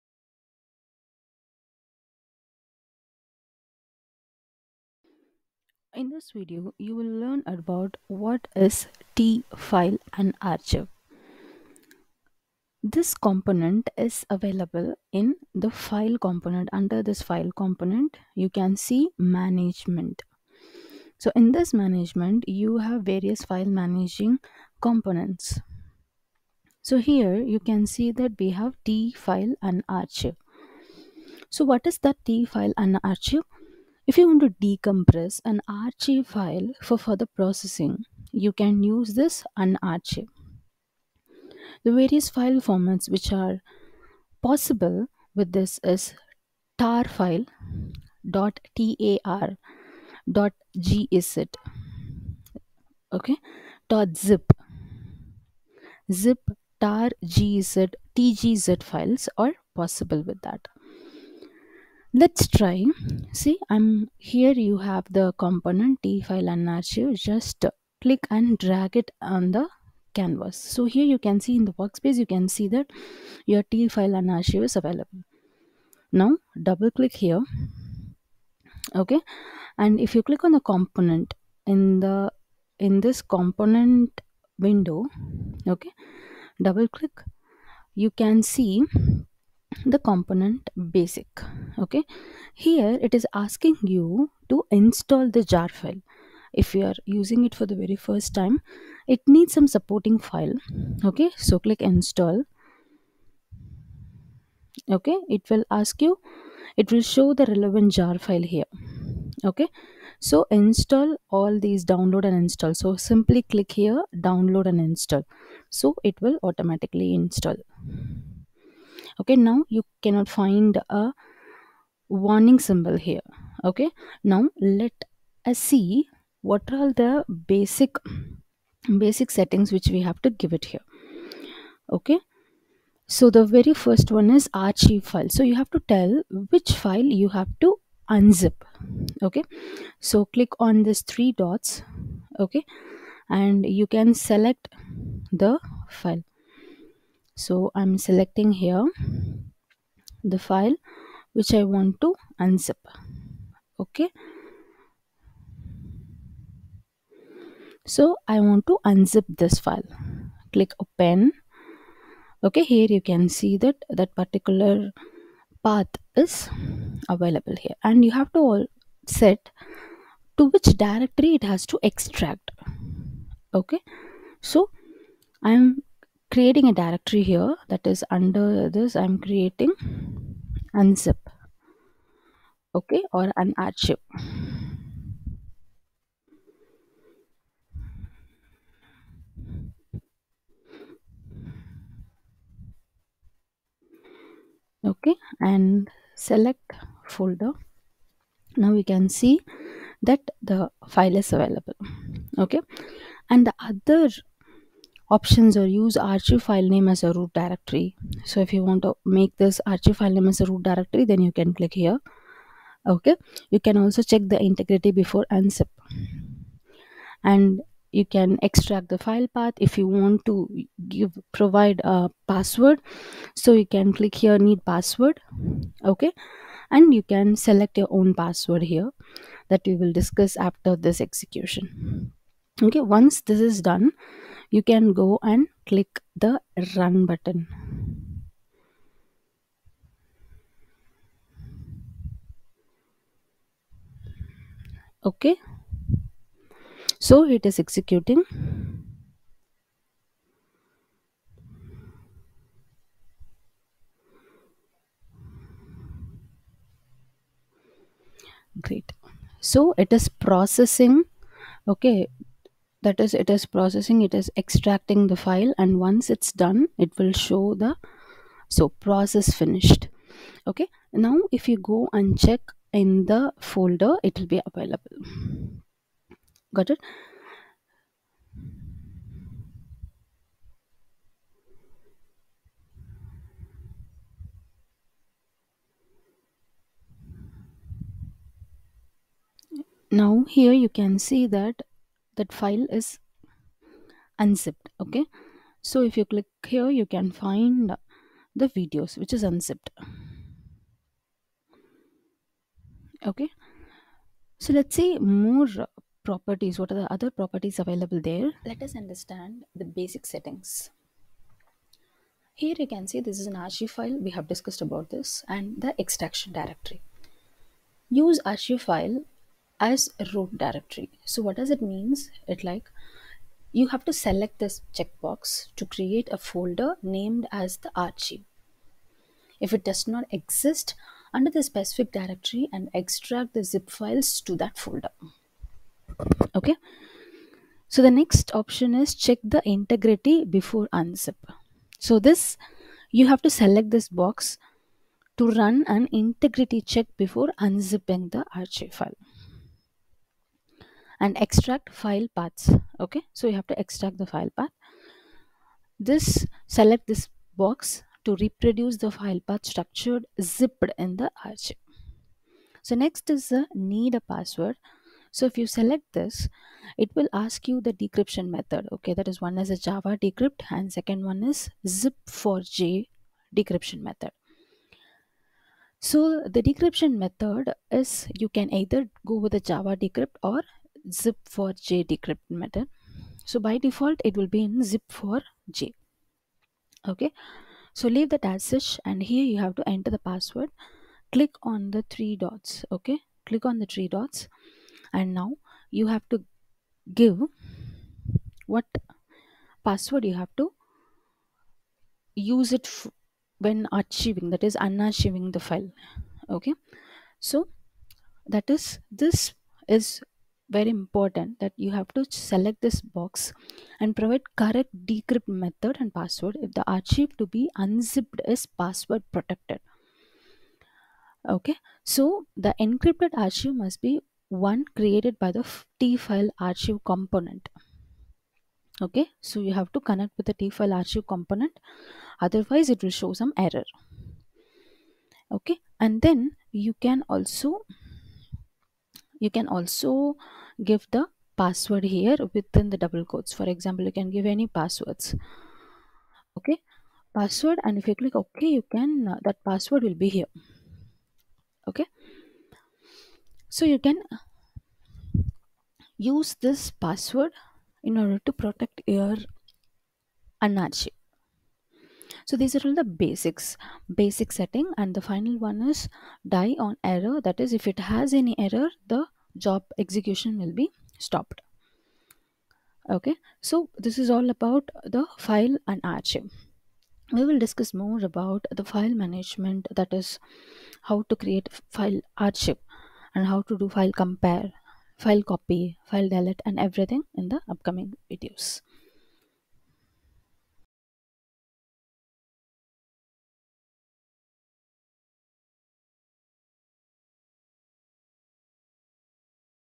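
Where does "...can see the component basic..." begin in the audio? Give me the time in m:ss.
1:28.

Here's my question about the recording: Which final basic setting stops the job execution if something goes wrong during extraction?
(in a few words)
die on error.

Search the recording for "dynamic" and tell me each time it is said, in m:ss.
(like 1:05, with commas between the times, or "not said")
not said.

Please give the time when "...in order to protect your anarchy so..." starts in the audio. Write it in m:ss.
7:37.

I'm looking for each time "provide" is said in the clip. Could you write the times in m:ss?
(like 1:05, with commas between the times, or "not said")
3:41, 6:53.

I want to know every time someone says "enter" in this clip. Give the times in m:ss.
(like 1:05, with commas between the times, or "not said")
6:29.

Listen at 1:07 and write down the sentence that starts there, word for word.
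Just click and drag it on the canvas.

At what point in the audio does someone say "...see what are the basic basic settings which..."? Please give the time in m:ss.
2:05.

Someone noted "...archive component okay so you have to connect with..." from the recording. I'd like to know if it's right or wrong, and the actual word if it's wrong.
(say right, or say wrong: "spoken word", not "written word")
right.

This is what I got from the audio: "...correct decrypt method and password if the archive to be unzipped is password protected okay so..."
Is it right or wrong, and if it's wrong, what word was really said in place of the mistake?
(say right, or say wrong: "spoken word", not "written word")
right.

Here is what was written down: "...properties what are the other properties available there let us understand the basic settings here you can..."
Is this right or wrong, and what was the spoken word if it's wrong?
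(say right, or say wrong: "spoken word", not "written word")
right.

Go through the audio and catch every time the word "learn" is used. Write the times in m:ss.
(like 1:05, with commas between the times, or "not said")
0:07.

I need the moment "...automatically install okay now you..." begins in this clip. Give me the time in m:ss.
1:56.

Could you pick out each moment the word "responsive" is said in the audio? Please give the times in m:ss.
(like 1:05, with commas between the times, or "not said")
not said.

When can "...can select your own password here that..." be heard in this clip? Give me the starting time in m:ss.
3:47.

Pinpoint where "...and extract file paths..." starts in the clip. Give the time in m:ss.
5:51.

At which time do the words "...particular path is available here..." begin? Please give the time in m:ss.
2:44.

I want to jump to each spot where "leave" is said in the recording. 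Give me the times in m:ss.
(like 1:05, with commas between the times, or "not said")
6:27.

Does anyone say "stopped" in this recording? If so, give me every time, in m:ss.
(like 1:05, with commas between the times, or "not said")
7:50.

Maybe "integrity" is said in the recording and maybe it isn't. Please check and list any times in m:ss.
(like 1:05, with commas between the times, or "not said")
3:34, 5:39, 5:45.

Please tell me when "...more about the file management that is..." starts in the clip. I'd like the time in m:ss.
7:57.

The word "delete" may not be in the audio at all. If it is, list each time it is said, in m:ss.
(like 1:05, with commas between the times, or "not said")
8:06.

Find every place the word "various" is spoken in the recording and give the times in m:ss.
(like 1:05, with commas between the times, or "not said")
0:23, 0:41.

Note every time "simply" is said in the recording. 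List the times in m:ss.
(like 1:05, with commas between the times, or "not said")
1:52.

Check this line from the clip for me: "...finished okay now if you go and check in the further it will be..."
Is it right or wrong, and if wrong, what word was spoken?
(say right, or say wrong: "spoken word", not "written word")
wrong: "folder", not "further".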